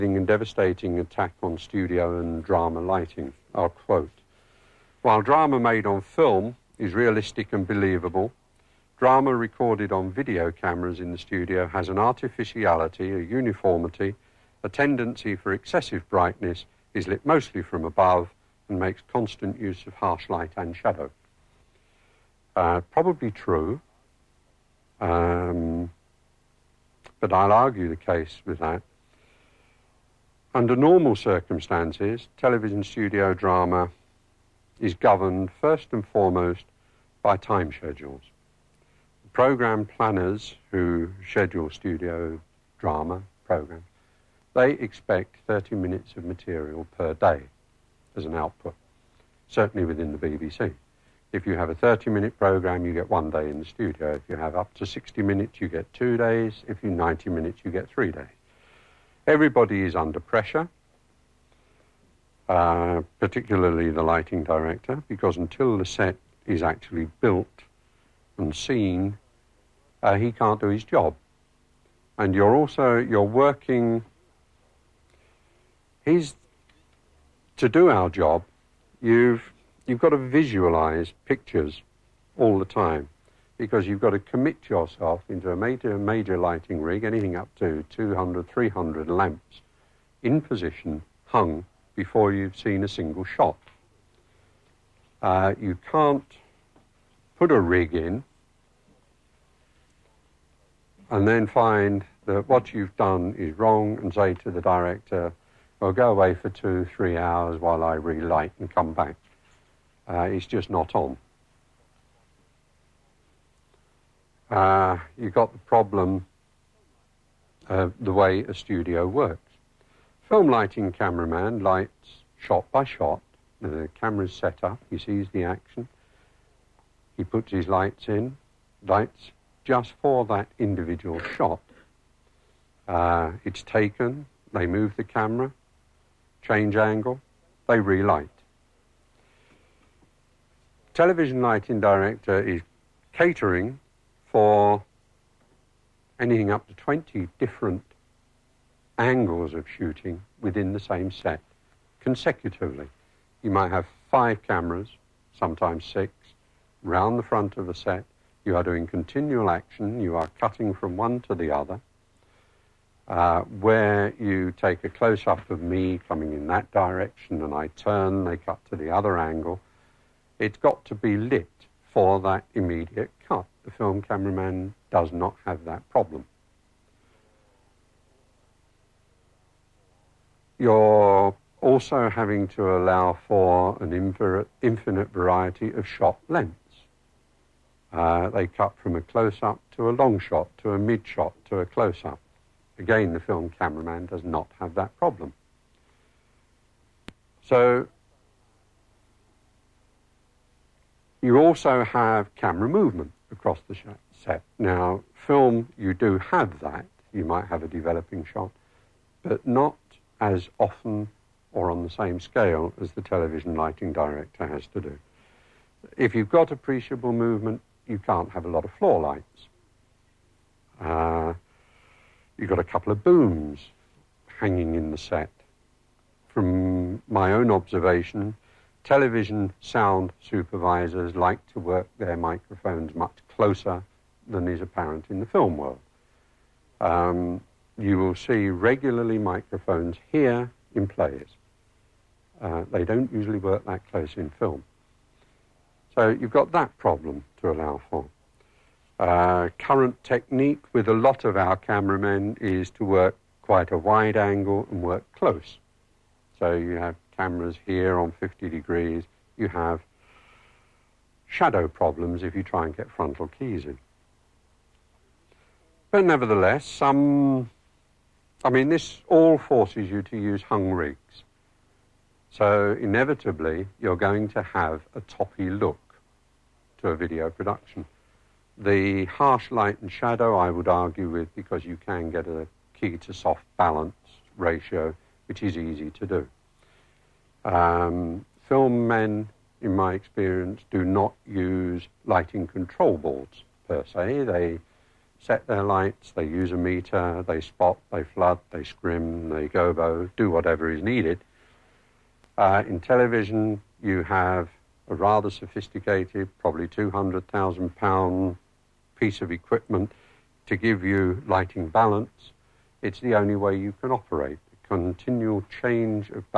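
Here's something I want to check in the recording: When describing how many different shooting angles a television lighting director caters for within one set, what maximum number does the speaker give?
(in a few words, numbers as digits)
20.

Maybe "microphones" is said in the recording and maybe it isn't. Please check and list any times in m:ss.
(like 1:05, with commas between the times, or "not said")
3:52, 3:59.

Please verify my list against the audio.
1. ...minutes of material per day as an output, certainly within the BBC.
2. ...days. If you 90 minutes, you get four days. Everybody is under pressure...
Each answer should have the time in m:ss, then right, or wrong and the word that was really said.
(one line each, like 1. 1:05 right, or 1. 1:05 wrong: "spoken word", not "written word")
1. 0:45 right
2. 0:56 wrong: "three", not "four".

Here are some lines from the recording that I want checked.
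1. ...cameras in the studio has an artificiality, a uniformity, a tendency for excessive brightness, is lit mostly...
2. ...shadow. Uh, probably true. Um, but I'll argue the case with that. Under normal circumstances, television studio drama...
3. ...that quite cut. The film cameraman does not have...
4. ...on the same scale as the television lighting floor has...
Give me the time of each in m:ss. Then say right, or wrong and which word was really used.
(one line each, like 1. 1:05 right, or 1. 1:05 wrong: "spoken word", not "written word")
1. 0:10 right
2. 0:20 right
3. 2:52 wrong: "immediate", not "quite"
4. 3:31 wrong: "director", not "floor".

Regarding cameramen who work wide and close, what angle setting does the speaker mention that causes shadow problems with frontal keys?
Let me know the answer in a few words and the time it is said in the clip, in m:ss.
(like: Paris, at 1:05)
50 degrees, at 4:18.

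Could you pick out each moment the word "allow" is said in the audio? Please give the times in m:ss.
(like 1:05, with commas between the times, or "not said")
3:02, 4:07.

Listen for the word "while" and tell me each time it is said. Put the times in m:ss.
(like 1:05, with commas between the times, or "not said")
0:05, 1:47.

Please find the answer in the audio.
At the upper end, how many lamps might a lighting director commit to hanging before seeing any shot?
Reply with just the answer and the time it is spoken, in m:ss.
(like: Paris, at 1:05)
300, at 1:28.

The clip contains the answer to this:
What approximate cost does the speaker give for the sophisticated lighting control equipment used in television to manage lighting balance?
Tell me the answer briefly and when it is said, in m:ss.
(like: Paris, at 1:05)
£200,000, at 5:06.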